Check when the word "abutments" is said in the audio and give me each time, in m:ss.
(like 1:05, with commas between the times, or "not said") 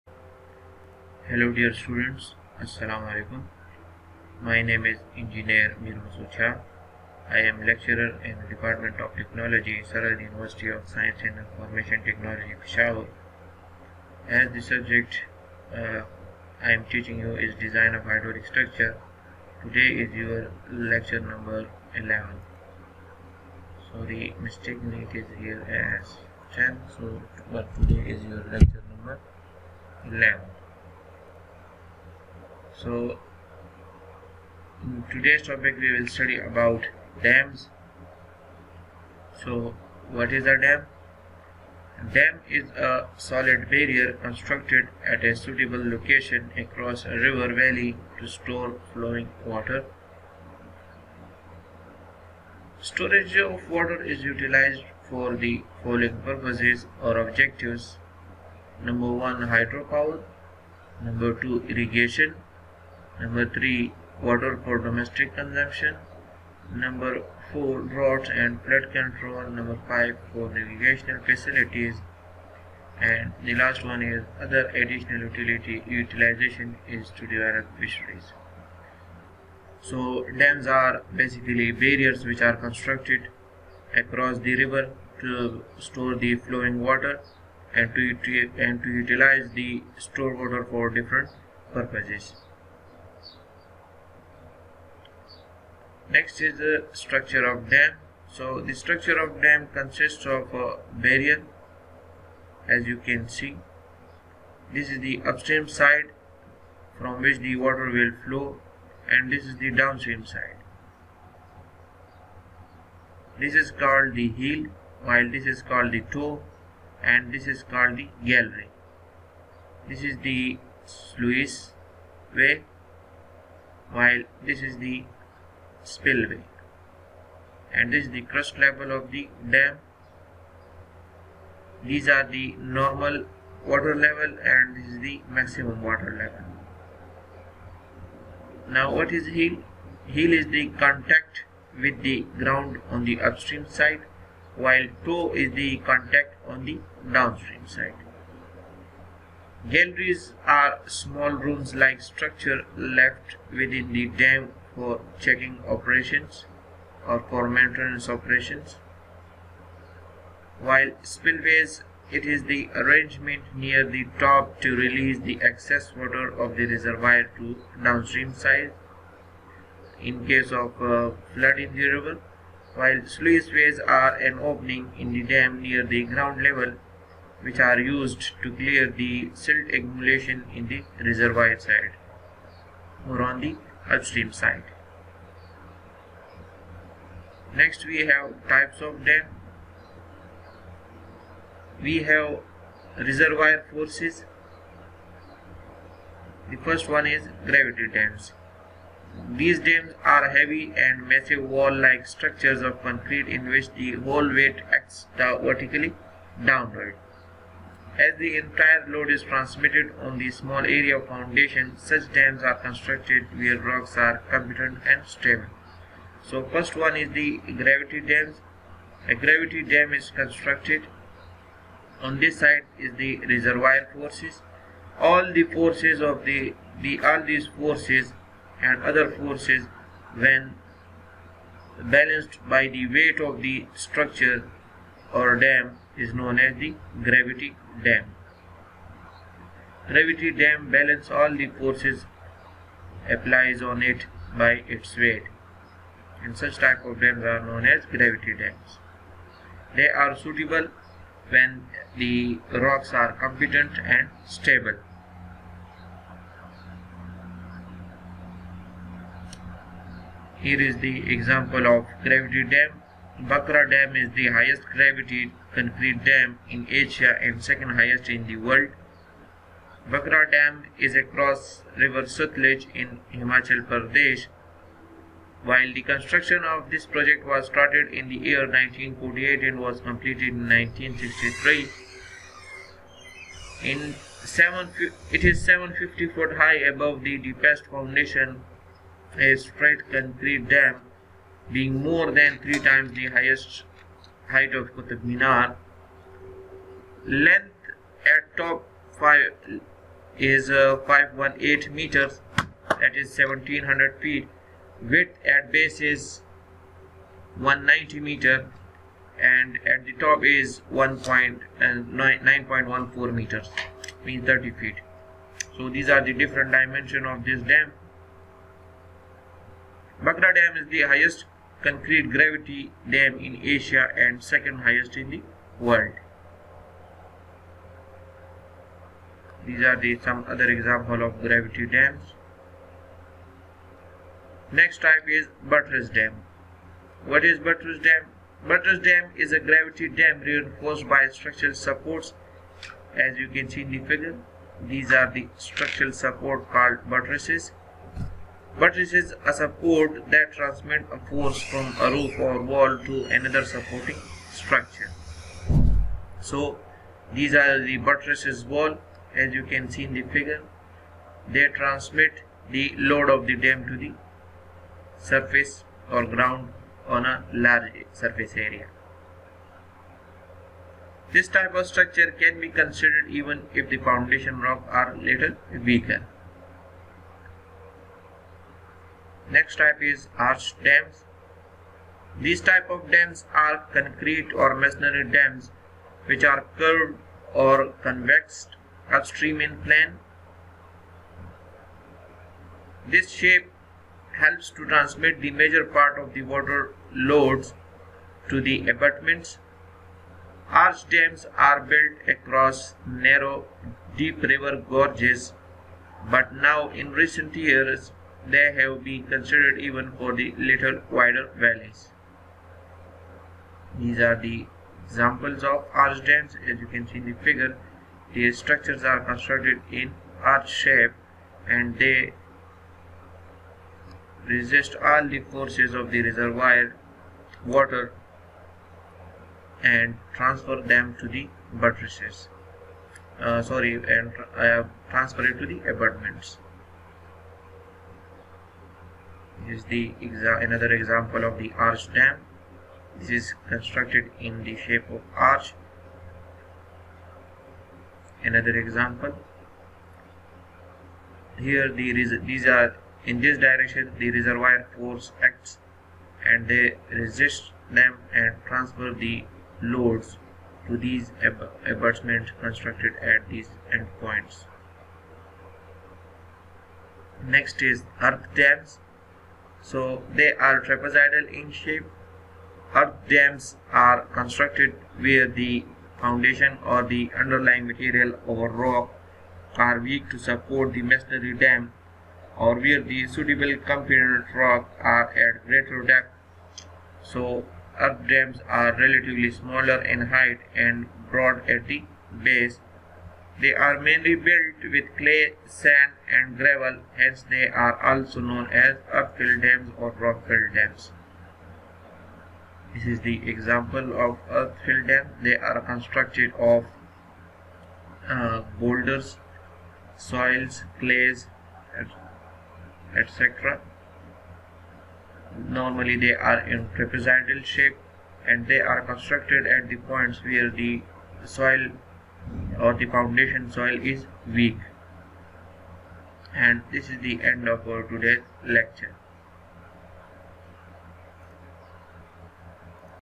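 6:38, 7:15, 7:41.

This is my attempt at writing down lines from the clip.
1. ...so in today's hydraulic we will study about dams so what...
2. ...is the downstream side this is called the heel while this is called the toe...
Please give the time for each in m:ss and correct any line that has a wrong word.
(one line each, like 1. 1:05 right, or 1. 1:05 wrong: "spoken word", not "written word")
1. 0:32 wrong: "topic", not "hydraulic"
2. 1:49 right.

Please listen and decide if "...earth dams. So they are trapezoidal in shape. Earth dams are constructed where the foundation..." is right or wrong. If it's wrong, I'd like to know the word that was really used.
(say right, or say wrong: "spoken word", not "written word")
right.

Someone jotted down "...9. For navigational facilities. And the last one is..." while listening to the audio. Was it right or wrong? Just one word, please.
wrong.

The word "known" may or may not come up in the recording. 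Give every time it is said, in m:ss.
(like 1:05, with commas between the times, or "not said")
3:56, 4:07, 8:18.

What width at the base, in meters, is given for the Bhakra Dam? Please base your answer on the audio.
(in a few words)
190 meters.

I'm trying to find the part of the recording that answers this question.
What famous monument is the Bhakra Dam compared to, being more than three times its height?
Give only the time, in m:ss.
4:54.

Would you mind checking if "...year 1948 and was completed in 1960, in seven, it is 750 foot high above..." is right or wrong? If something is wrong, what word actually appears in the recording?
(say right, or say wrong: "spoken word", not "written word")
wrong: "1963", not "1960".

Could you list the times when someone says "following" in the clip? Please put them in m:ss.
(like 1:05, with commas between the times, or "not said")
0:55.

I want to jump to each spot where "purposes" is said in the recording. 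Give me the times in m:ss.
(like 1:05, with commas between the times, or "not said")
0:56, 1:31.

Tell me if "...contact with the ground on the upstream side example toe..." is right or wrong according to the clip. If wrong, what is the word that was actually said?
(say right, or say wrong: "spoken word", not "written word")
wrong: "while", not "example".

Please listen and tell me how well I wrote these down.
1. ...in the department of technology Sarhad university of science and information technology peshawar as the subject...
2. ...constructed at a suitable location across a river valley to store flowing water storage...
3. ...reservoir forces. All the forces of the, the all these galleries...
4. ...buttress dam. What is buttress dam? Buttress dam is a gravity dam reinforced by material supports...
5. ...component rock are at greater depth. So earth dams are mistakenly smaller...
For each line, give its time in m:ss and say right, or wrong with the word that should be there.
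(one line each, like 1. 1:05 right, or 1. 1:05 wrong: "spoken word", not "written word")
1. 0:08 right
2. 0:44 right
3. 3:43 wrong: "forces", not "galleries"
4. 5:35 wrong: "structural", not "material"
5. 8:03 wrong: "relatively", not "mistakenly".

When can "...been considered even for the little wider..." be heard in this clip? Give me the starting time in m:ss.
6:48.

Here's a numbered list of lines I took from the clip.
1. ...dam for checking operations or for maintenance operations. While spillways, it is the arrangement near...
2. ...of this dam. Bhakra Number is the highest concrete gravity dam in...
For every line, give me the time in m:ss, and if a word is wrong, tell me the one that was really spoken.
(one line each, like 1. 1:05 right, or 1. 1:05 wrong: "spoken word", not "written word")
1. 2:34 right
2. 5:17 wrong: "Dam", not "Number".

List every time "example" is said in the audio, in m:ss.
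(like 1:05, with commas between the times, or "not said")
4:21, 5:30, 6:54, 7:20, 7:28, 8:23.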